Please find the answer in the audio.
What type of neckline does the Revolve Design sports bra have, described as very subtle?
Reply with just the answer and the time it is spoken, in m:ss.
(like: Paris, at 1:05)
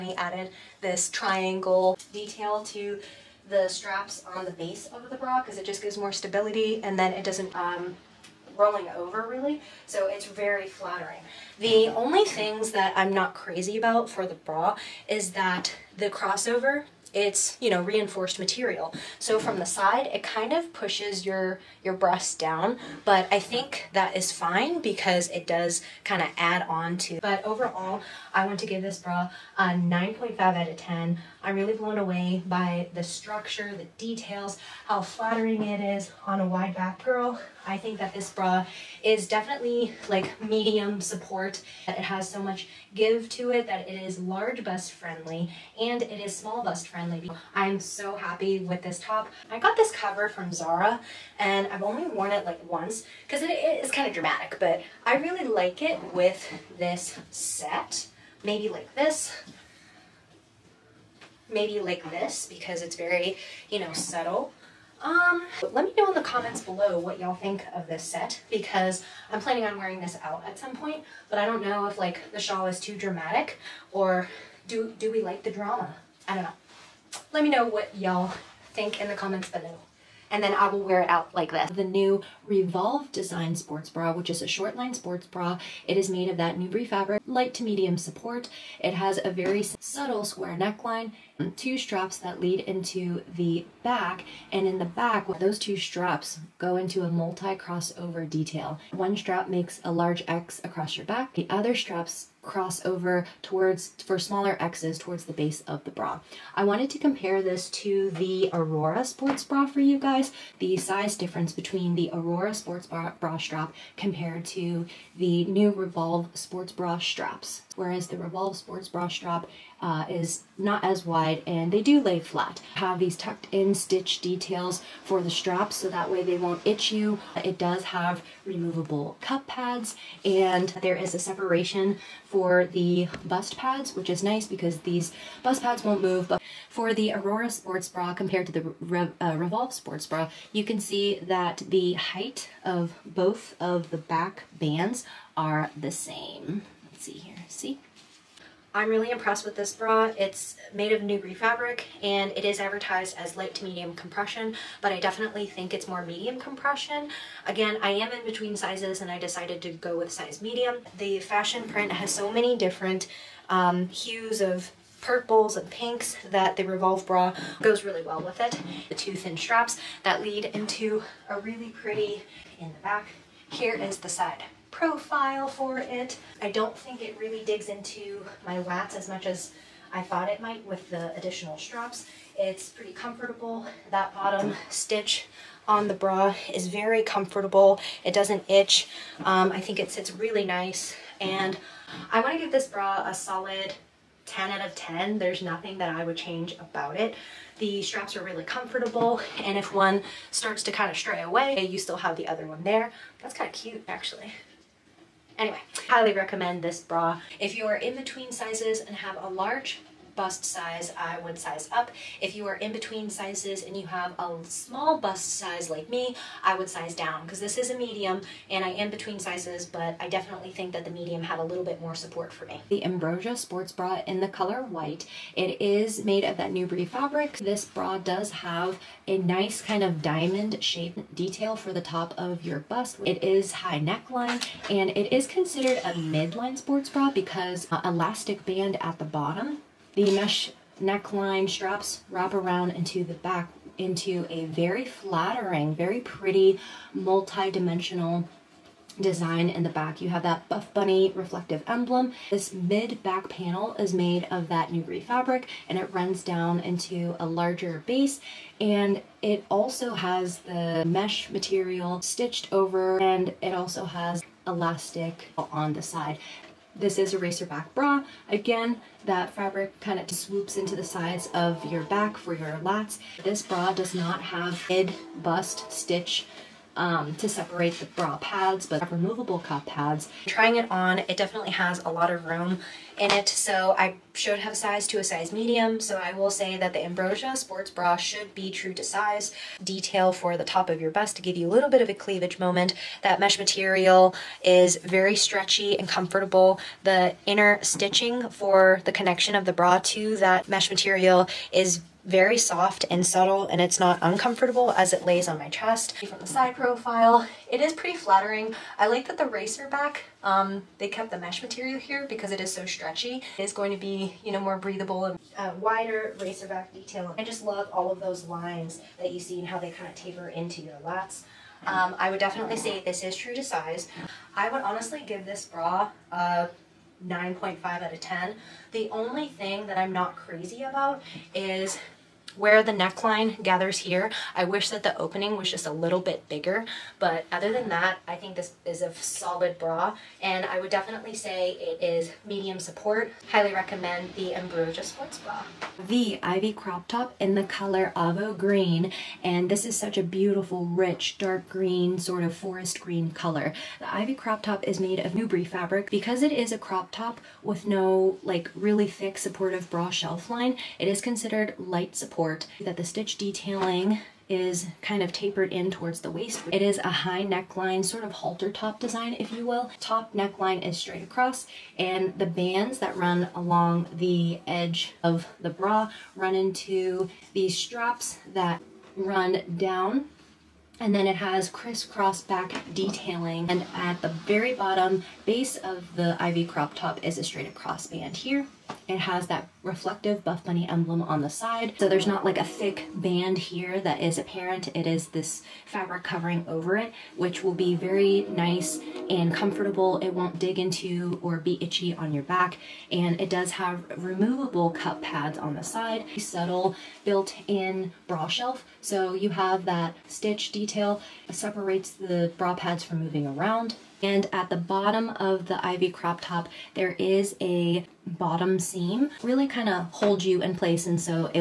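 square neckline, at 1:30.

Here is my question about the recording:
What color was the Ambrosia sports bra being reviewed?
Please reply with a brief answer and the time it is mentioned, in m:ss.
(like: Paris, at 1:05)
white, at 3:44.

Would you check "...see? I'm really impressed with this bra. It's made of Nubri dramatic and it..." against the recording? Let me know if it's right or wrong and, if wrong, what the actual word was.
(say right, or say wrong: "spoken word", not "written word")
wrong: "fabric", not "dramatic".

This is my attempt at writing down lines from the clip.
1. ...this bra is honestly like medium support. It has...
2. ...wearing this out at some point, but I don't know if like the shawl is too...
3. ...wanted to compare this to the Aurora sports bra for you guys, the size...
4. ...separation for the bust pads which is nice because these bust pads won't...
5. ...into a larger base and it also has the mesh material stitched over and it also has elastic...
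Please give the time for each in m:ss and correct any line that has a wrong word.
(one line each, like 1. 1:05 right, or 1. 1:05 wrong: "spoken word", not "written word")
1. 0:38 wrong: "definitely", not "honestly"
2. 1:09 right
3. 1:46 right
4. 2:11 right
5. 4:16 right.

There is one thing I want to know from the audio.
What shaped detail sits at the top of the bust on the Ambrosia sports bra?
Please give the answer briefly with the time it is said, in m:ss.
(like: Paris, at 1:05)
diamond shape, at 3:50.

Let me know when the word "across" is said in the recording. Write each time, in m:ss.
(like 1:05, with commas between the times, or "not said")
1:40, 6:11, 6:27.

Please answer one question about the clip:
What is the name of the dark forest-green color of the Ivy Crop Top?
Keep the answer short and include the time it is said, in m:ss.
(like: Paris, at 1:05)
Avo Green, at 5:47.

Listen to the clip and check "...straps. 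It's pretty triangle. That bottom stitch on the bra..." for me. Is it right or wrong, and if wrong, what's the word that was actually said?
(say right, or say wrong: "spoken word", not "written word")
wrong: "comfortable", not "triangle".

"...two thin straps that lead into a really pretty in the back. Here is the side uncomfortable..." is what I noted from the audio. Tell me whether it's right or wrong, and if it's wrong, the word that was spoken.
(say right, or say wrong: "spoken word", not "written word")
wrong: "profile", not "uncomfortable".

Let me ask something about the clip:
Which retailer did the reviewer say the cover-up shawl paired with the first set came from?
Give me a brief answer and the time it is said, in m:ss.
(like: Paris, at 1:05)
Zara, at 0:50.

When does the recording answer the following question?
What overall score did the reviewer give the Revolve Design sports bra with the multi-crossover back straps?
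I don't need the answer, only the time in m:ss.
3:14.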